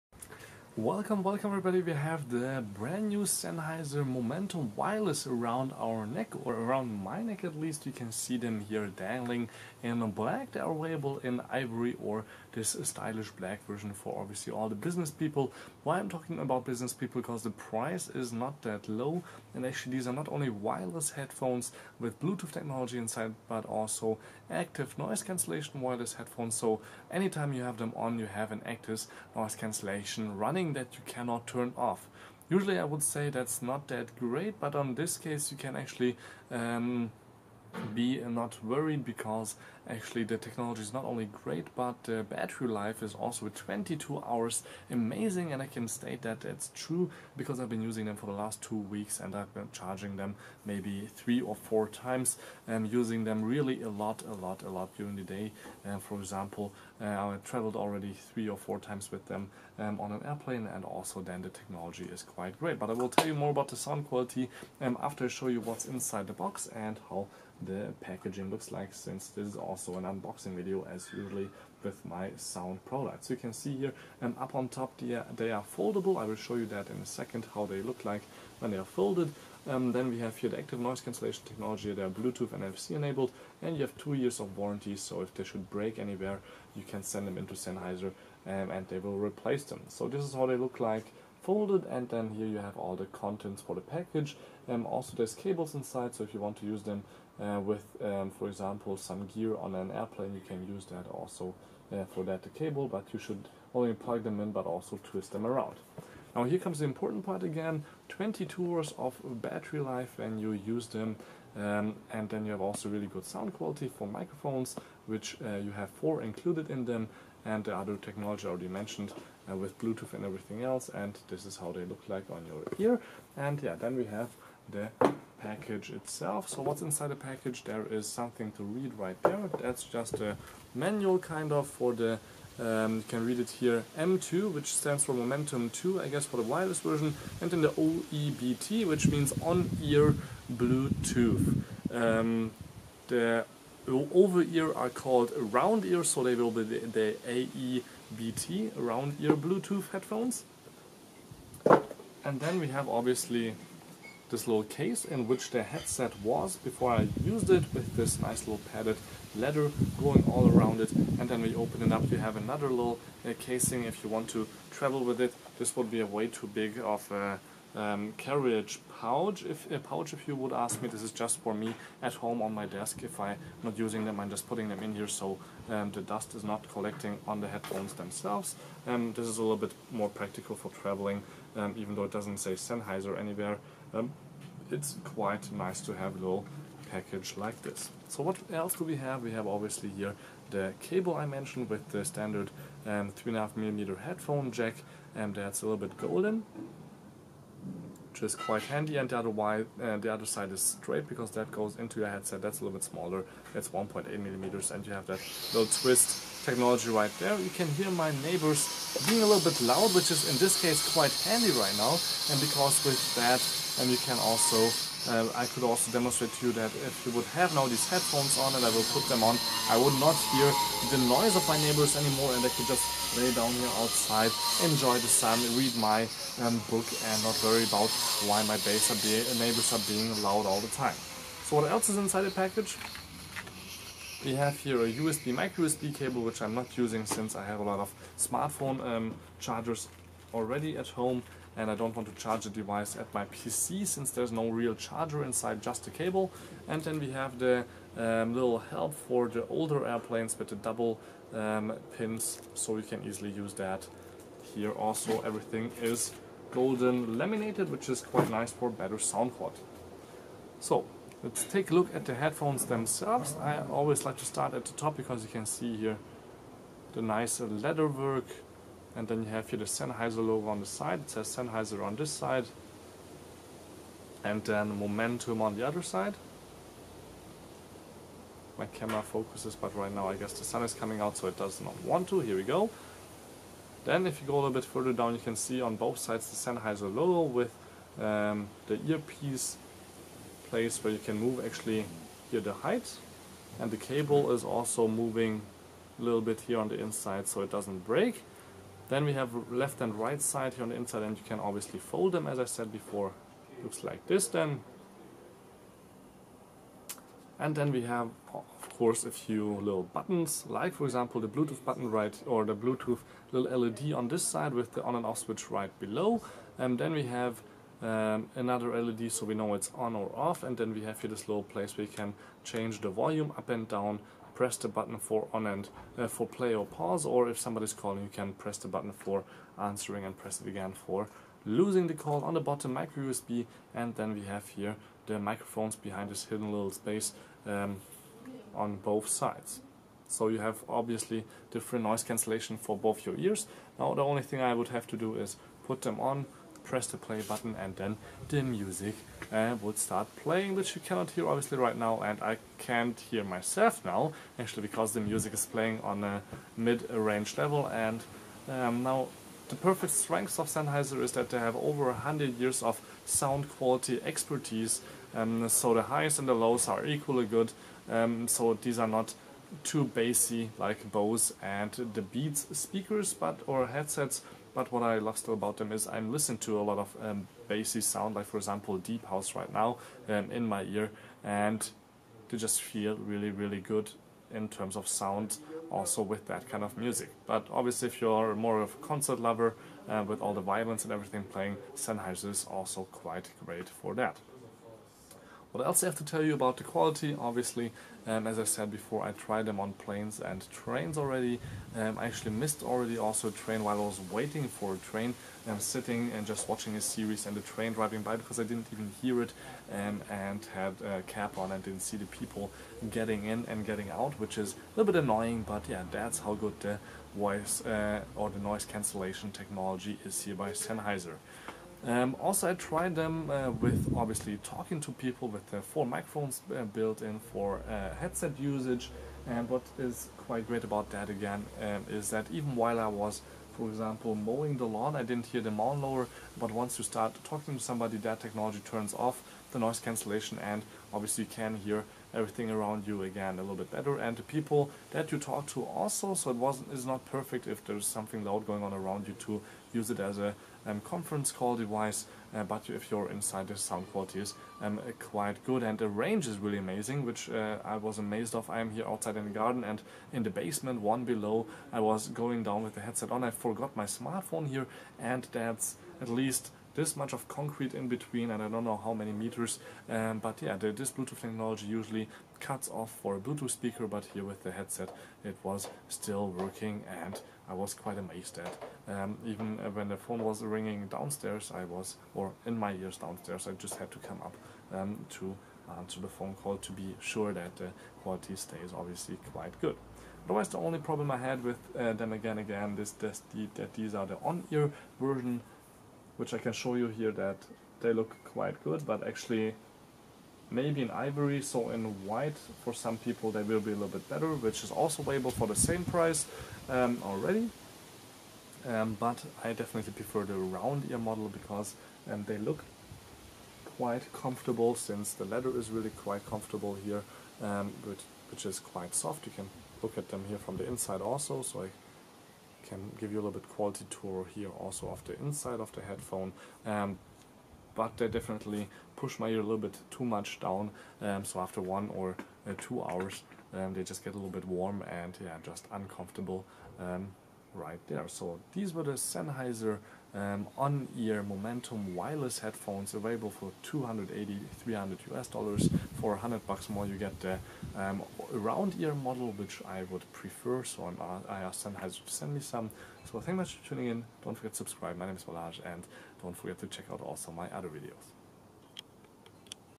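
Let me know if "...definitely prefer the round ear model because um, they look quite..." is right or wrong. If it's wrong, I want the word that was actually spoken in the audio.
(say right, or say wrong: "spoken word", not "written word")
right.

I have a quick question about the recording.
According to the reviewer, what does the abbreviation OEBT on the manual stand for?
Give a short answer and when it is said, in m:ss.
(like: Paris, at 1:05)
On-ear Bluetooth, at 2:19.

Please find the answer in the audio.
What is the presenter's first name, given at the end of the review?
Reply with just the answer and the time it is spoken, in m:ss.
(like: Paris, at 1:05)
Balazs, at 9:15.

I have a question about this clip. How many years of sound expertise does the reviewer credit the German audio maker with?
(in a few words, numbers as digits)
Over 100 years.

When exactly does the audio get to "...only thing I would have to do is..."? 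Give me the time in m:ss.
5:44.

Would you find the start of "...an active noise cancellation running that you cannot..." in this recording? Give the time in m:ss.
0:28.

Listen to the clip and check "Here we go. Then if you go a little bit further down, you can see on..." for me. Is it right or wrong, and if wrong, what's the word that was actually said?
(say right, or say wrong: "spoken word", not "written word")
right.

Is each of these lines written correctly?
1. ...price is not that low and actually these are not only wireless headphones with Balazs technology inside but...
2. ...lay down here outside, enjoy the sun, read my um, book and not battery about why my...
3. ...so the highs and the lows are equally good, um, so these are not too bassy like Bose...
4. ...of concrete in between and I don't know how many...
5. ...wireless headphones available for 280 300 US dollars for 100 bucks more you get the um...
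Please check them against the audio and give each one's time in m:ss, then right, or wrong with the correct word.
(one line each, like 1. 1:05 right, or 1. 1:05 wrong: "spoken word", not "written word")
1. 0:17 wrong: "Bluetooth", not "Balazs"
2. 3:43 wrong: "worry", not "battery"
3. 6:05 right
4. 7:47 right
5. 9:01 right.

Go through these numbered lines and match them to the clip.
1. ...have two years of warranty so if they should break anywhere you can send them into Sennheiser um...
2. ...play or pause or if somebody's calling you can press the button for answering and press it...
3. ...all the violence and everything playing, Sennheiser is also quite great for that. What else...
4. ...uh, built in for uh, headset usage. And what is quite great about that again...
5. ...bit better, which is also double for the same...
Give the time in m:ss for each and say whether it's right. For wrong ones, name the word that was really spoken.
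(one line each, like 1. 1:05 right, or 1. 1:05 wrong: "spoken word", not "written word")
1. 1:23 right
2. 5:26 right
3. 6:30 right
4. 7:06 right
5. 8:23 wrong: "available", not "double".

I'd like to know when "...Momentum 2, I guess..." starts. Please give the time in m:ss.
2:15.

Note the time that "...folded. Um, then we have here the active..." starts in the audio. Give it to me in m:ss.
1:18.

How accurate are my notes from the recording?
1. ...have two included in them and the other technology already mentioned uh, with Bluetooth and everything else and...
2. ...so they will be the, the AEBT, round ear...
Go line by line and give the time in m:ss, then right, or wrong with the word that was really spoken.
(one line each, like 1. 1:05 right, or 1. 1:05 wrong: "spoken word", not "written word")
1. 1:55 wrong: "four", not "two"
2. 2:26 right.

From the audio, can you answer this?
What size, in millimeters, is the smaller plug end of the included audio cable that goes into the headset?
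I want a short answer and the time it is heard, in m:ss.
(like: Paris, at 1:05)
1.8 millimeters, at 3:23.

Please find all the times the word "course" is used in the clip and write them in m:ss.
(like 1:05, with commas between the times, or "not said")
5:08.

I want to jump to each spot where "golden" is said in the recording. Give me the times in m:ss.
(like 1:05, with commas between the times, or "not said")
3:15, 4:16.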